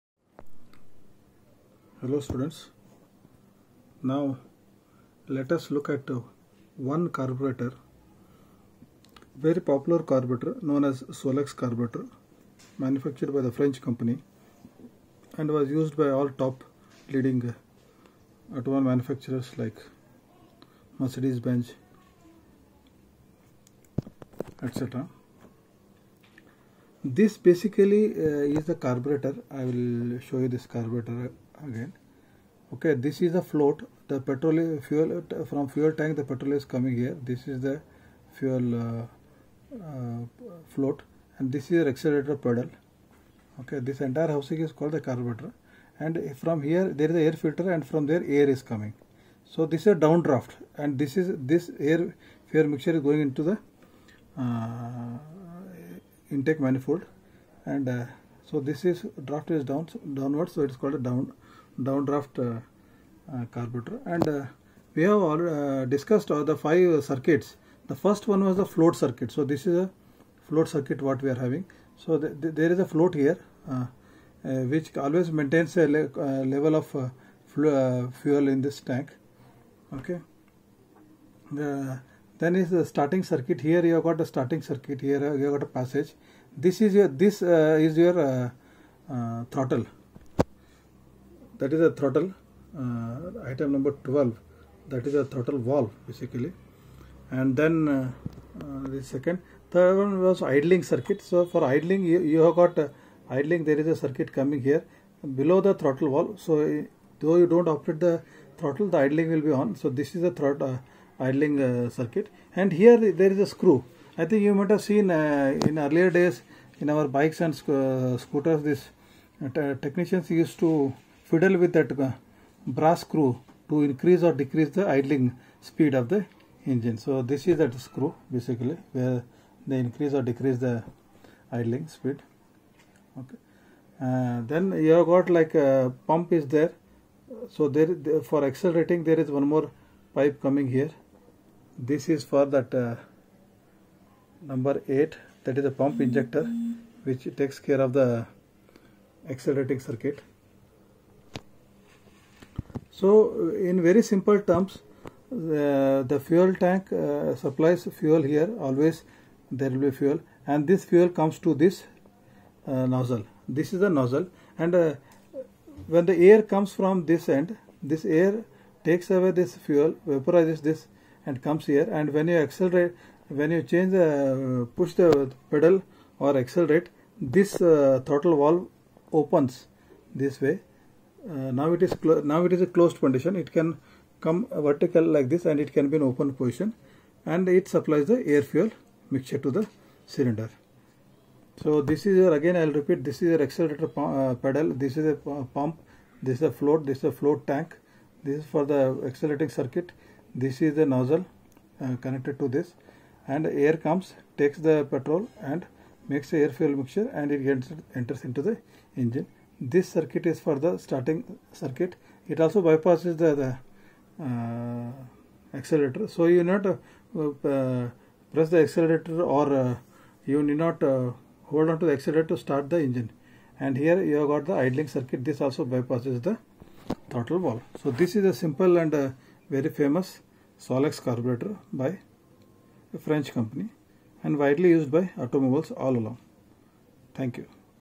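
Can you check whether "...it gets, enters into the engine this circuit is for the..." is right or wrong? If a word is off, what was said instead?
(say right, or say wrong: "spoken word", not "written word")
right.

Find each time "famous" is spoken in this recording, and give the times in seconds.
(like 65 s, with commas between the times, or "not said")
229 s.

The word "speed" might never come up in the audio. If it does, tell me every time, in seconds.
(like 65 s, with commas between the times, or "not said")
125 s, 131 s.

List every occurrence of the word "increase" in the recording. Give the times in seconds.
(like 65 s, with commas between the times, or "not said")
123 s, 129 s.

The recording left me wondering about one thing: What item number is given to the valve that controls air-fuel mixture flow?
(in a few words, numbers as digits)
12.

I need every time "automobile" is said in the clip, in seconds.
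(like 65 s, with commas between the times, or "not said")
18 s, 235 s.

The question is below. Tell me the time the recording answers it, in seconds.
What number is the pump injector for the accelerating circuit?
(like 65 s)
144 s.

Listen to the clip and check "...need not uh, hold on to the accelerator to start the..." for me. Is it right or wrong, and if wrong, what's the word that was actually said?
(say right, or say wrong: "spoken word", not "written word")
right.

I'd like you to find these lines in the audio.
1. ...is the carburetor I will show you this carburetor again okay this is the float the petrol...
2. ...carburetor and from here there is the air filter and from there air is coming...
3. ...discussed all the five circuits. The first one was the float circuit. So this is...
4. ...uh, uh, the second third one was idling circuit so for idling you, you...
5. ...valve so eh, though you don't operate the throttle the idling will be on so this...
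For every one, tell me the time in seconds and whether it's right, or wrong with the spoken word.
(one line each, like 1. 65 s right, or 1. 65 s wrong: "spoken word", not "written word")
1. 28 s right
2. 45 s right
3. 65 s right
4. 97 s right
5. 106 s right.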